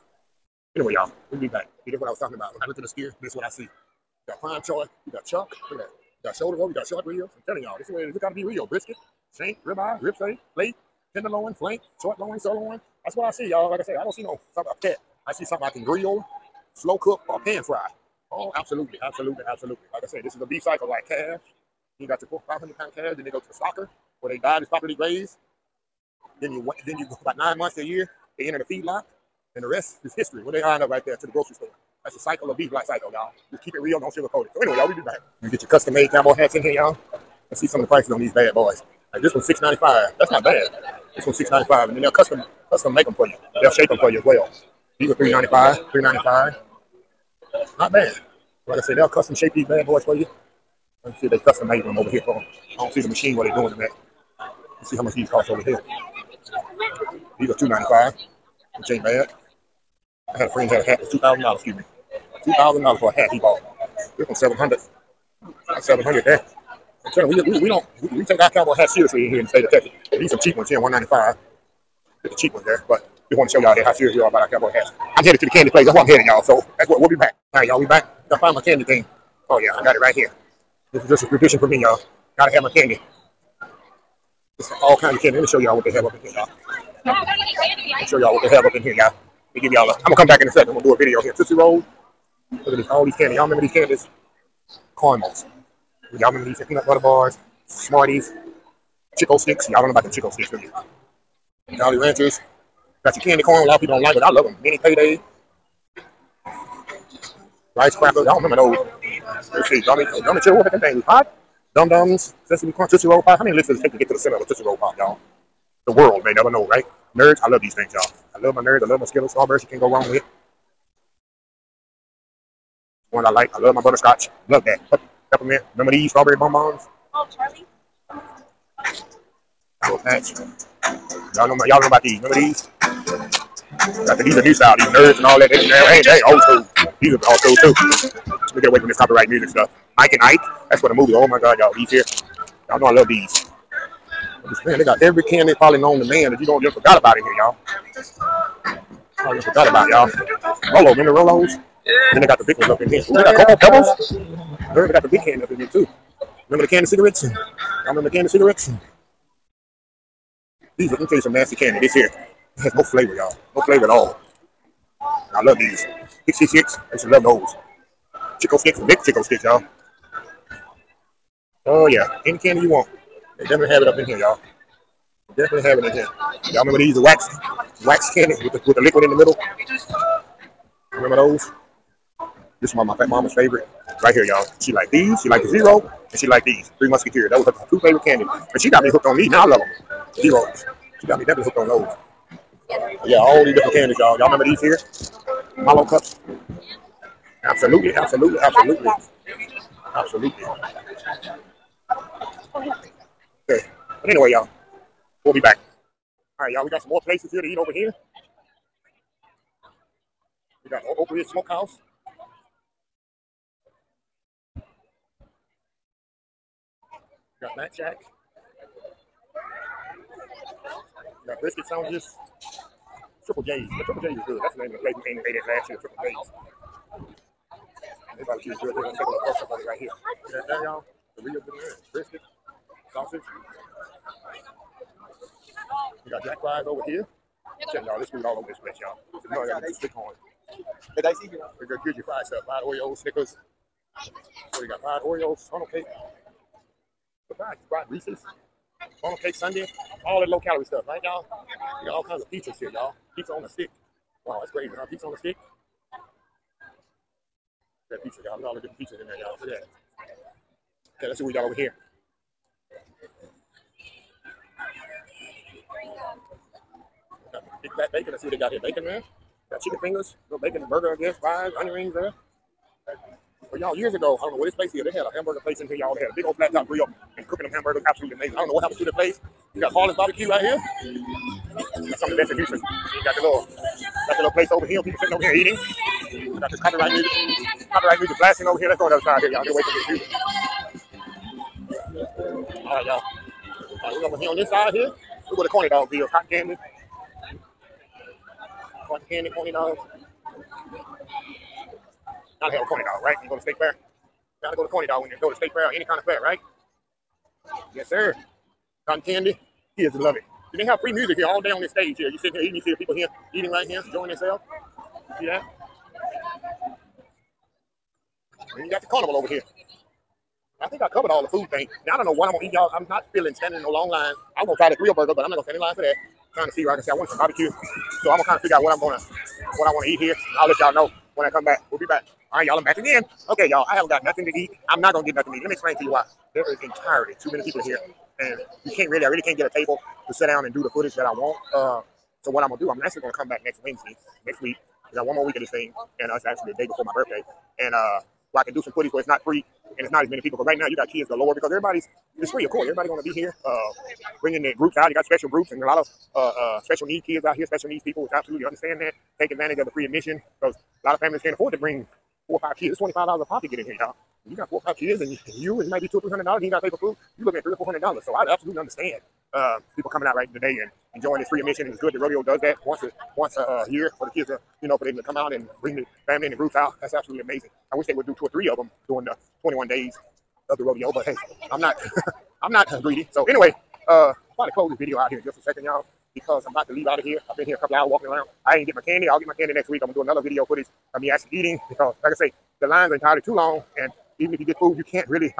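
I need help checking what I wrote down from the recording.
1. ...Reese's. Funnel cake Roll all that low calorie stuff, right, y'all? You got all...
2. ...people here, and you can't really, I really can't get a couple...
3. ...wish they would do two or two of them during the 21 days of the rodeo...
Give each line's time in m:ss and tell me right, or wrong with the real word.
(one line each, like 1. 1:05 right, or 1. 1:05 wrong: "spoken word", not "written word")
1. 4:07 wrong: "Sunday", not "Roll"
2. 5:37 wrong: "table", not "couple"
3. 6:17 wrong: "three", not "two".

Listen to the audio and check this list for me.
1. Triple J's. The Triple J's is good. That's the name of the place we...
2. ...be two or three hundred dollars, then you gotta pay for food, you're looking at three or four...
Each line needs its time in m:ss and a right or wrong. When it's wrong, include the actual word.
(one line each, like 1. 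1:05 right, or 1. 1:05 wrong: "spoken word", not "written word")
1. 3:43 right
2. 6:05 right.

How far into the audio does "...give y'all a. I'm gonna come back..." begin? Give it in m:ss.
1:29.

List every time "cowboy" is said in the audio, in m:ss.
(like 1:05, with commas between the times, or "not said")
0:36, 1:08, 1:14.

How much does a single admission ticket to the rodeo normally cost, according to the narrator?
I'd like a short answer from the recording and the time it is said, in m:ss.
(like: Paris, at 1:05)
$25, at 6:02.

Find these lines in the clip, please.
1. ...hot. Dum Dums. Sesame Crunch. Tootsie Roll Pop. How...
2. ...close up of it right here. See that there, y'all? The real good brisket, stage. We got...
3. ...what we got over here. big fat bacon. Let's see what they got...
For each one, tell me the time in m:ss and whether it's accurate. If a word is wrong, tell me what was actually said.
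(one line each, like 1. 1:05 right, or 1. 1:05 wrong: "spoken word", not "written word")
1. 1:51 right
2. 3:49 wrong: "sausage", not "stage"
3. 4:21 right.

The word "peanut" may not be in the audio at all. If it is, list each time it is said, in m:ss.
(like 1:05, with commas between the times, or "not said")
1:36.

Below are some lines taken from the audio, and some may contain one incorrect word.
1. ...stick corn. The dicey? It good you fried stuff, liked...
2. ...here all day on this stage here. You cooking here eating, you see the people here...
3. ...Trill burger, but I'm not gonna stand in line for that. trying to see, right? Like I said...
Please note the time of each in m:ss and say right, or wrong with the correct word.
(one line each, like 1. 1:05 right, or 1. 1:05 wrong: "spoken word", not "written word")
1. 3:59 wrong: "fried", not "liked"
2. 5:11 wrong: "sitting", not "cooking"
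3. 5:24 right.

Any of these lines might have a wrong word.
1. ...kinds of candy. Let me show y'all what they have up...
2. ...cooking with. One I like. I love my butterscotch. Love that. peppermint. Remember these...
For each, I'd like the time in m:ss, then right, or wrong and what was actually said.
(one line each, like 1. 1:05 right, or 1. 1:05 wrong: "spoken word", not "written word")
1. 1:24 right
2. 1:59 wrong: "wrong", not "cooking".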